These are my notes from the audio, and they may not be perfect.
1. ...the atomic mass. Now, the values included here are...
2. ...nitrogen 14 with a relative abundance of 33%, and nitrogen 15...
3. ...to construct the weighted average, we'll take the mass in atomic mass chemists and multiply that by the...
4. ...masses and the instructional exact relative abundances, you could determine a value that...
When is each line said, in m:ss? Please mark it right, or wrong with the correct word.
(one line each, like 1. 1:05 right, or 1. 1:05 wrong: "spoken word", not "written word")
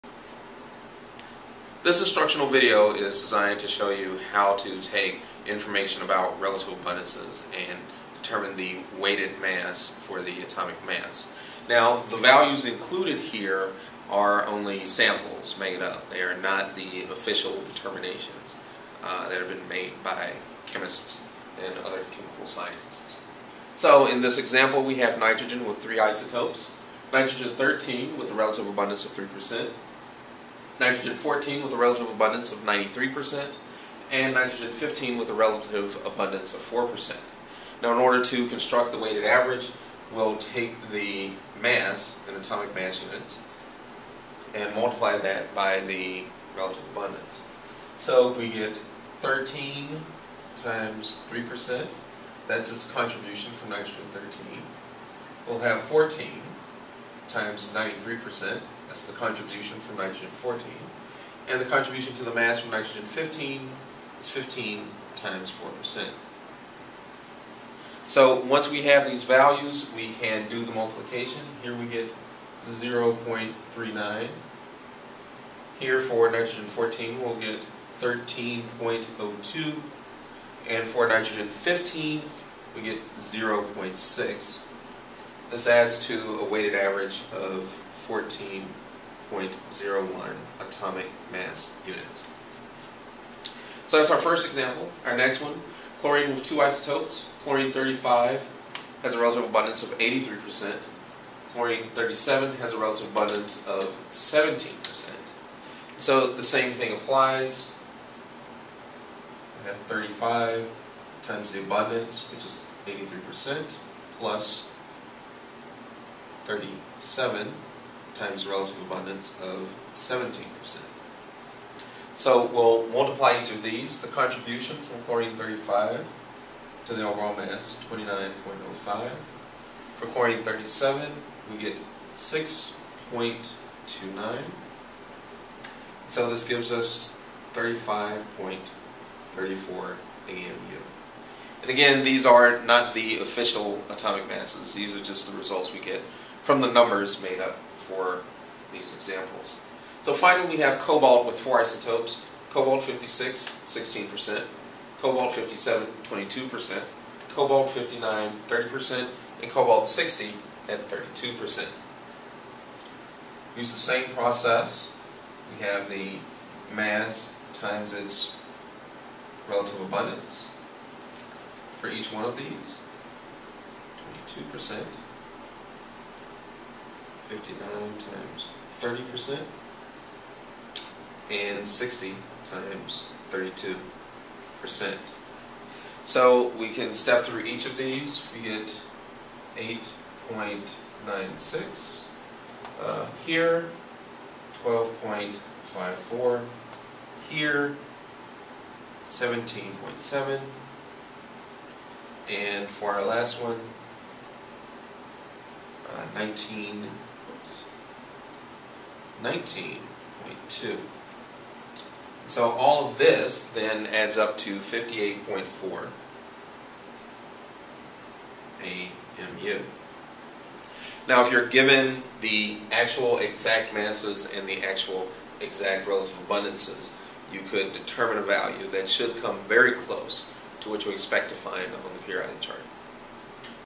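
1. 0:10 right
2. 0:30 wrong: "93", not "33"
3. 0:38 wrong: "units", not "chemists"
4. 3:43 wrong: "actual", not "instructional".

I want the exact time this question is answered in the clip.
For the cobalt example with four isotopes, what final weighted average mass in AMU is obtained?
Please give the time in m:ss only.
3:34.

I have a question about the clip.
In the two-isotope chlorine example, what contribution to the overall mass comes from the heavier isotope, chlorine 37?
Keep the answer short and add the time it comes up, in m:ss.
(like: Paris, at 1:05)
6.29, at 2:12.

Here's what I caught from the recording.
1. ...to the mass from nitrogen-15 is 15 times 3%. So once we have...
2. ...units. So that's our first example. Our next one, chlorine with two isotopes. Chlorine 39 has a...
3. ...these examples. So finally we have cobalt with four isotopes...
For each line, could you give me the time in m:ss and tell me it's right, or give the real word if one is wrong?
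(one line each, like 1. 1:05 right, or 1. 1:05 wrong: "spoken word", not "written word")
1. 1:02 wrong: "4", not "3"
2. 1:31 wrong: "35", not "39"
3. 2:28 right.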